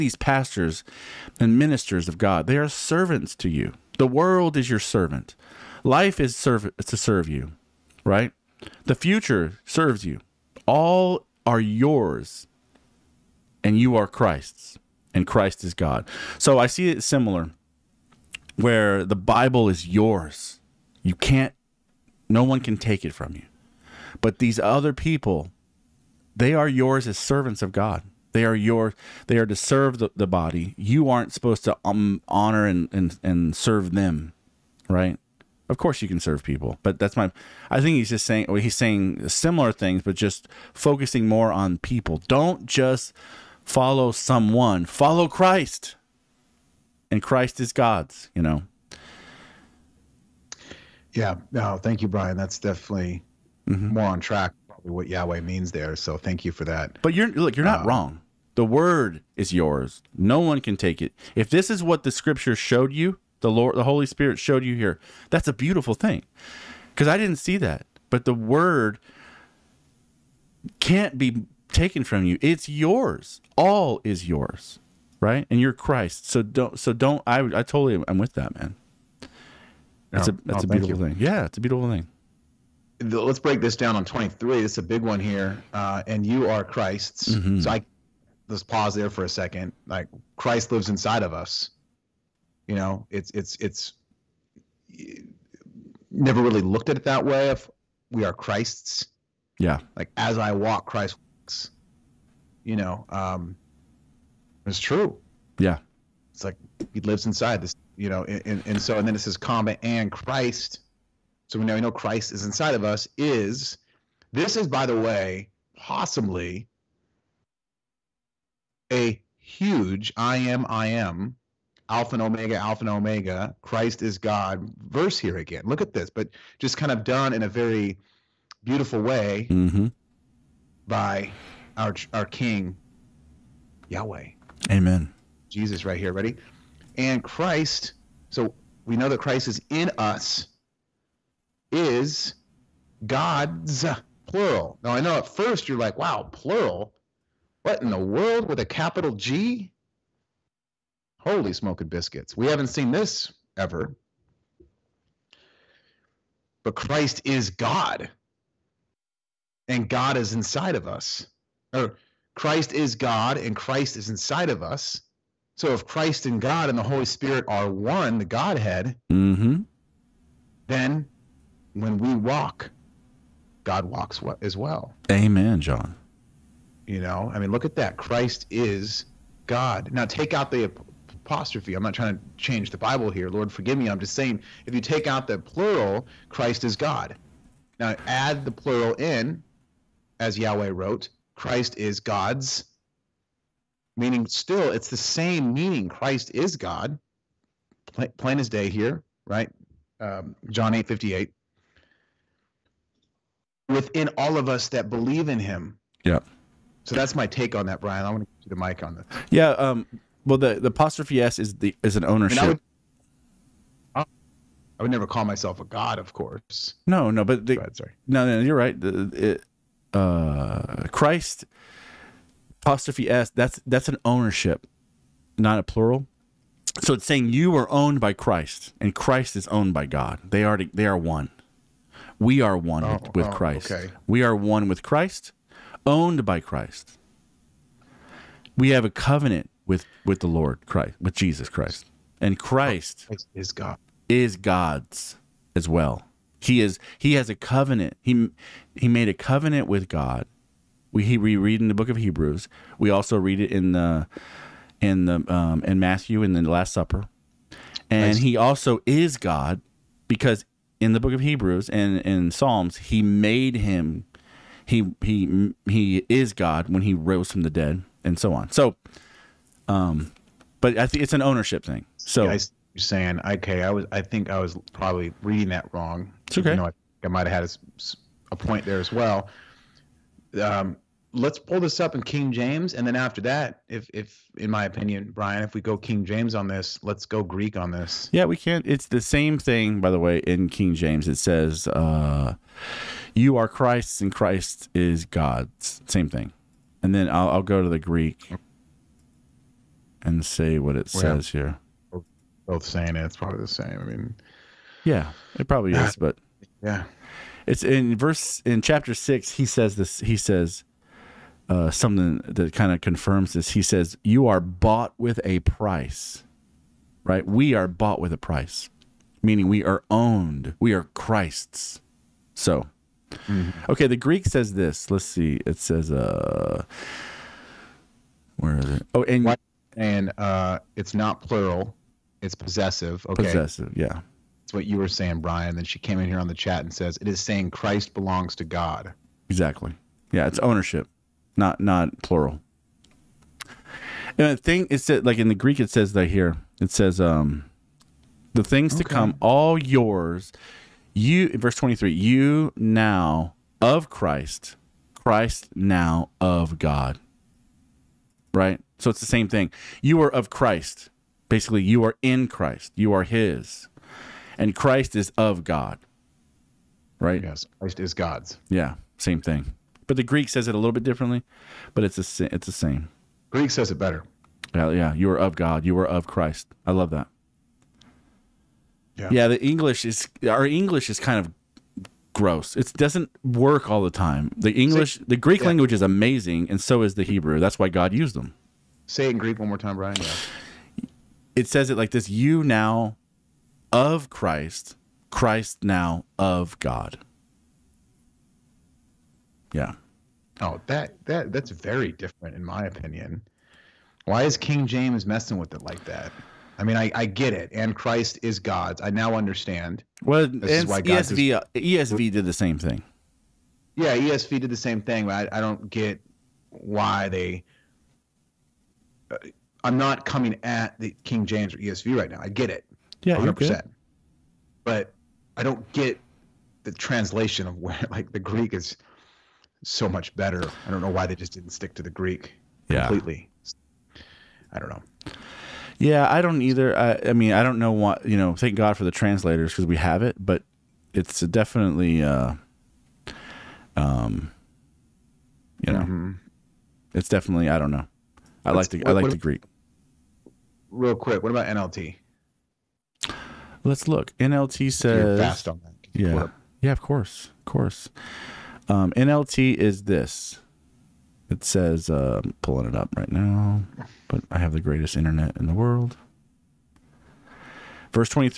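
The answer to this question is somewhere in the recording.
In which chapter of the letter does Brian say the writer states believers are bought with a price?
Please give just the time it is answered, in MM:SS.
05:08.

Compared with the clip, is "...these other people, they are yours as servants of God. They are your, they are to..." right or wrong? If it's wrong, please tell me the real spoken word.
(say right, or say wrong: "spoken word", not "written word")
right.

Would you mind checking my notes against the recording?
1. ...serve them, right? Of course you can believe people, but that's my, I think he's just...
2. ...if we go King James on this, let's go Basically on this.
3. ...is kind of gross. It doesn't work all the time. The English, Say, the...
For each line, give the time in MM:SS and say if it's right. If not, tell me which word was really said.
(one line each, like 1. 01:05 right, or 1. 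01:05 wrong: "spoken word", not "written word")
1. 00:33 wrong: "serve", not "believe"
2. 04:45 wrong: "Greek", not "Basically"
3. 06:20 right.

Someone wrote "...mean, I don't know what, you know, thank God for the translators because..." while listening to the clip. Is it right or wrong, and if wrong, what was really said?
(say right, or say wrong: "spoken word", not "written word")
right.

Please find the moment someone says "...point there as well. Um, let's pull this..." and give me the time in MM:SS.
04:38.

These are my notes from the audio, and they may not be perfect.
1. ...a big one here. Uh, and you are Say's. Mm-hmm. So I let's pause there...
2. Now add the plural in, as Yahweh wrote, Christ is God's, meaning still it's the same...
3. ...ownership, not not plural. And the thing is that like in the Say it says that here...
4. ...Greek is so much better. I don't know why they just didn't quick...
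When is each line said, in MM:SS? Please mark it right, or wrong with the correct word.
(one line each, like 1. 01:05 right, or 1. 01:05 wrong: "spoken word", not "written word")
1. 01:24 wrong: "Christ", not "Say"
2. 03:07 right
3. 05:40 wrong: "Greek", not "Say"
4. 07:08 wrong: "stick", not "quick".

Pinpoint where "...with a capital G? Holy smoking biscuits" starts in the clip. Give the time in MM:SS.
02:28.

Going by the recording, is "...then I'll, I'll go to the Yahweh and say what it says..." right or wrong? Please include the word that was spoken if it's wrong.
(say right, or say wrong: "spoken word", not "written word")
wrong: "Greek", not "Yahweh".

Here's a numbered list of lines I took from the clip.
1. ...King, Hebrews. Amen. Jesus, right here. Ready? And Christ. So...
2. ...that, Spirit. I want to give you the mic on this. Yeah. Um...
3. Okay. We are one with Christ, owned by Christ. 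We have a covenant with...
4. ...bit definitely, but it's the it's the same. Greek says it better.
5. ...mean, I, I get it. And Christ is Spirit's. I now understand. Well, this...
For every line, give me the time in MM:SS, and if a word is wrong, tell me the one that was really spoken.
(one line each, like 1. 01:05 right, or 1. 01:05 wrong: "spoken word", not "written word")
1. 02:12 wrong: "Yahweh", not "Hebrews"
2. 03:27 wrong: "Brian", not "Spirit"
3. 03:53 right
4. 06:10 wrong: "differently", not "definitely"
5. 06:46 wrong: "God", not "Spirit".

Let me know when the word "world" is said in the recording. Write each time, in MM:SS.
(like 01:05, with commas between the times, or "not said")
00:04, 02:27, 07:45.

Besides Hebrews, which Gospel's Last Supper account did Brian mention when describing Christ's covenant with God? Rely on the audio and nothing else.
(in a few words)
Matthew.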